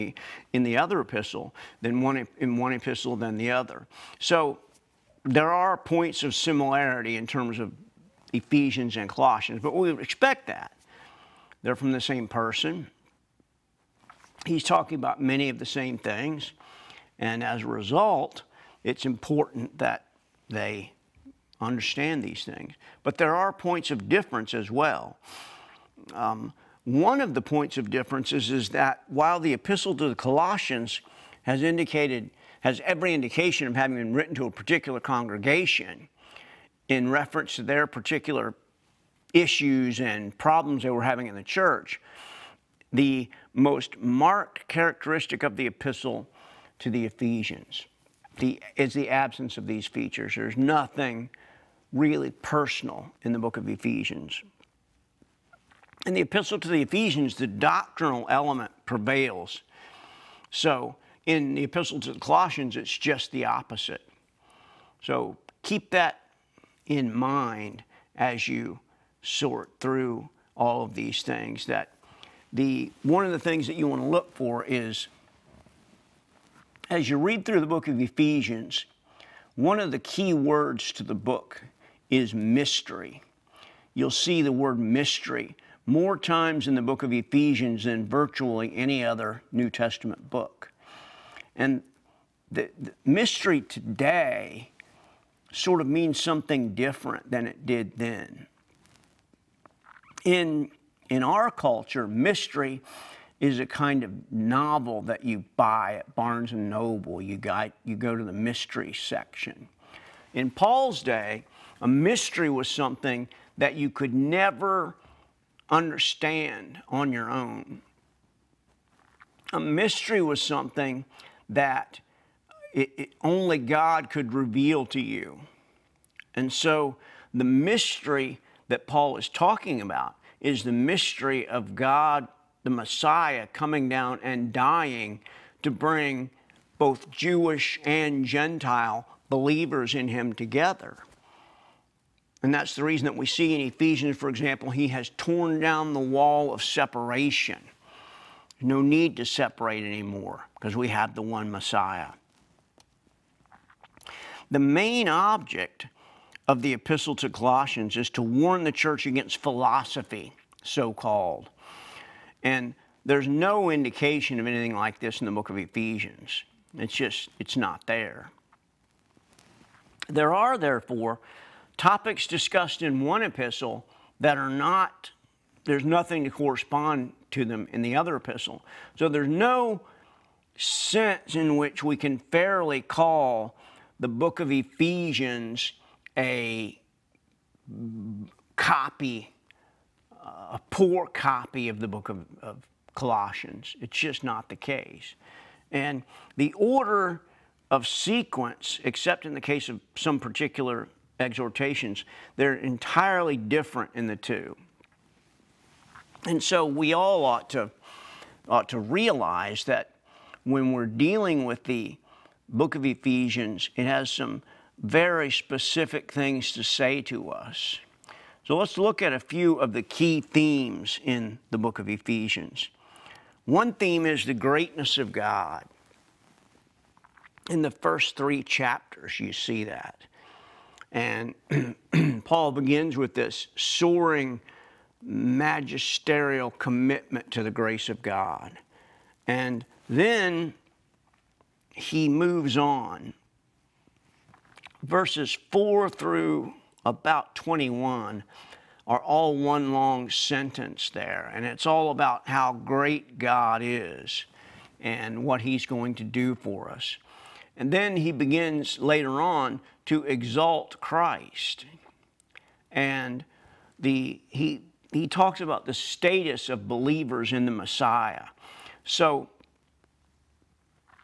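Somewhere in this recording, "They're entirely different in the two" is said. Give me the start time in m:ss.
3:22.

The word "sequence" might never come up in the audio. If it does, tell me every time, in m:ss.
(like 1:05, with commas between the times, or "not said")
3:17.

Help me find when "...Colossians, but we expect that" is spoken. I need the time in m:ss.
0:09.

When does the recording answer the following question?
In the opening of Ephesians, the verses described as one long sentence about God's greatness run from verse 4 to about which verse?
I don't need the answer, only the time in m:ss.
4:07.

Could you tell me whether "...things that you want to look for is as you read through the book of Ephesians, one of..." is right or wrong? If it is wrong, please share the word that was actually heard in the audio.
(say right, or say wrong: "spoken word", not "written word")
right.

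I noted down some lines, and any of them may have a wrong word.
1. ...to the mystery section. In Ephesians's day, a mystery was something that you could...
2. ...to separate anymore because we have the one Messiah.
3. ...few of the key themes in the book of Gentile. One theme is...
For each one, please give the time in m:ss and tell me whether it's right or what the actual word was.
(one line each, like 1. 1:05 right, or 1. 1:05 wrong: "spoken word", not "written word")
1. 1:48 wrong: "Paul", not "Ephesians"
2. 2:29 right
3. 3:39 wrong: "Ephesians", not "Gentile".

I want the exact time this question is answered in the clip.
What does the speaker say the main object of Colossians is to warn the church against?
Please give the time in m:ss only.
2:39.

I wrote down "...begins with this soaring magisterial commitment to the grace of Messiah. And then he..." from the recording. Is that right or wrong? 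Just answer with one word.
wrong.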